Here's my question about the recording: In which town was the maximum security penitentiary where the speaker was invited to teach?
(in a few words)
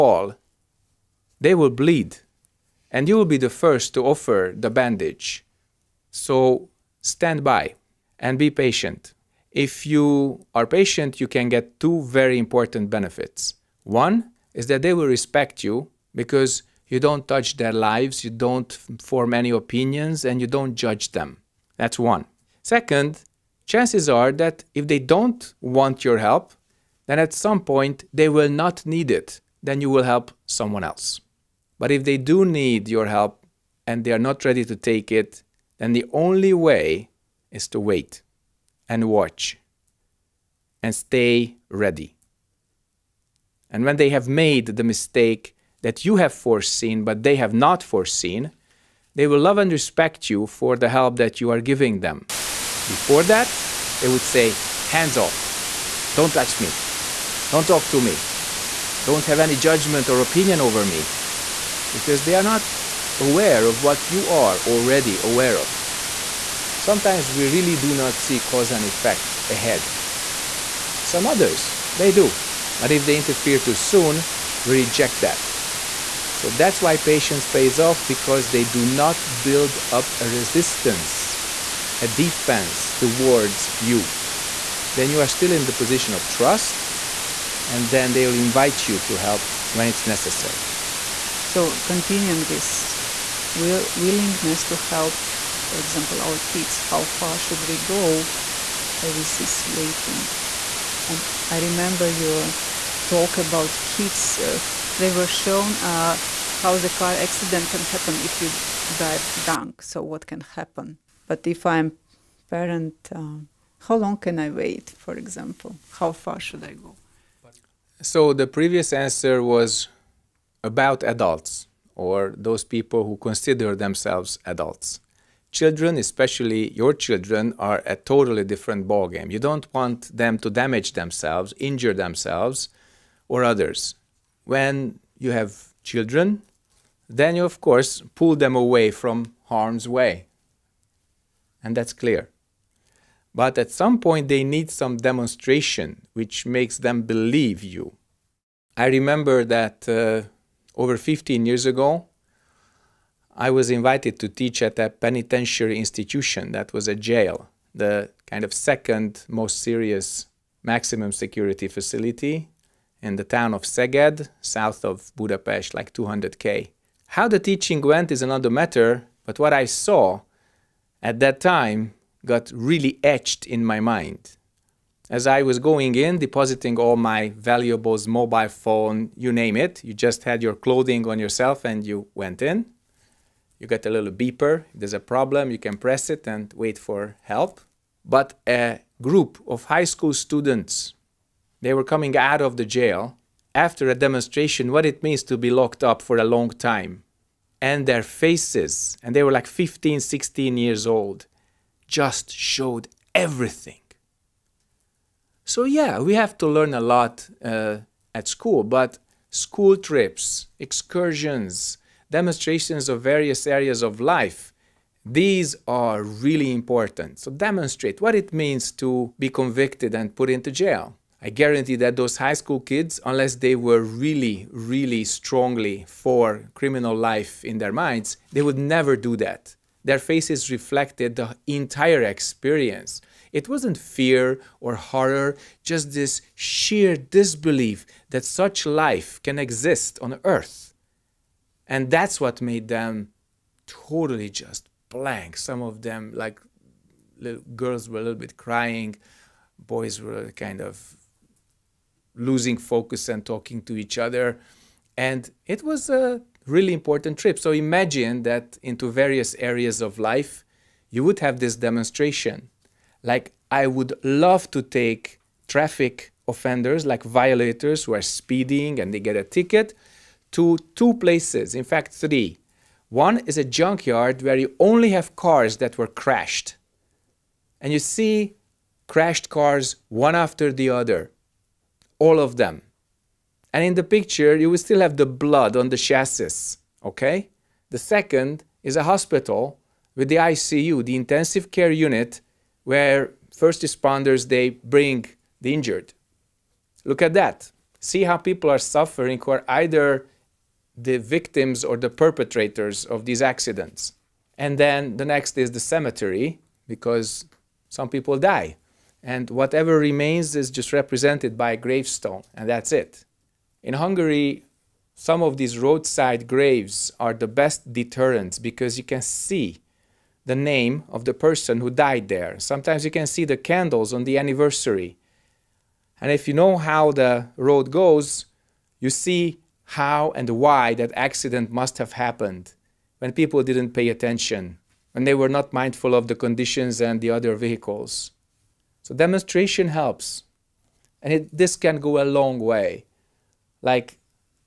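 Szeged.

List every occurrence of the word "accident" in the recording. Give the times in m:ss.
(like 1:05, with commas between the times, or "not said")
1:47, 5:03, 5:30.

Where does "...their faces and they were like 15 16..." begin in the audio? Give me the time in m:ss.
3:17.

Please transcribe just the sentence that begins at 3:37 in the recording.
So, demonstrate what it means to be convicted and put into jail.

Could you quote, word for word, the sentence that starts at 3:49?
Their faces reflected the entire experience.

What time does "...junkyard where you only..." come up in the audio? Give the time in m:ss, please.
4:33.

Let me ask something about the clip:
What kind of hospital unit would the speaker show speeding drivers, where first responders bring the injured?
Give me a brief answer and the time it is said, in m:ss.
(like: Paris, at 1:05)
ICU, at 4:50.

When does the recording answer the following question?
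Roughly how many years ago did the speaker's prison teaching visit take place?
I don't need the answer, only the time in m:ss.
2:30.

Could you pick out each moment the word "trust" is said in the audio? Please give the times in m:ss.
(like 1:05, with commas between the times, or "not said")
1:26.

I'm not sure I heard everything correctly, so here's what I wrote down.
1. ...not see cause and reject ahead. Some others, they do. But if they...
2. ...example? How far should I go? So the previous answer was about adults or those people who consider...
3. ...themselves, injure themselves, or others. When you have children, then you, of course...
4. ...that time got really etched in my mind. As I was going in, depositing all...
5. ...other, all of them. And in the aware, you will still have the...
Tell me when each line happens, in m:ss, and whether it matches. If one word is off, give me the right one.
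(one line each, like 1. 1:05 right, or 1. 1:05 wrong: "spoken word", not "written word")
1. 1:07 wrong: "effect", not "reject"
2. 1:55 right
3. 2:10 right
4. 2:51 right
5. 4:40 wrong: "picture", not "aware".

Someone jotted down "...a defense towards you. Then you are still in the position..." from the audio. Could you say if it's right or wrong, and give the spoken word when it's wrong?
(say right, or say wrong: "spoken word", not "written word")
right.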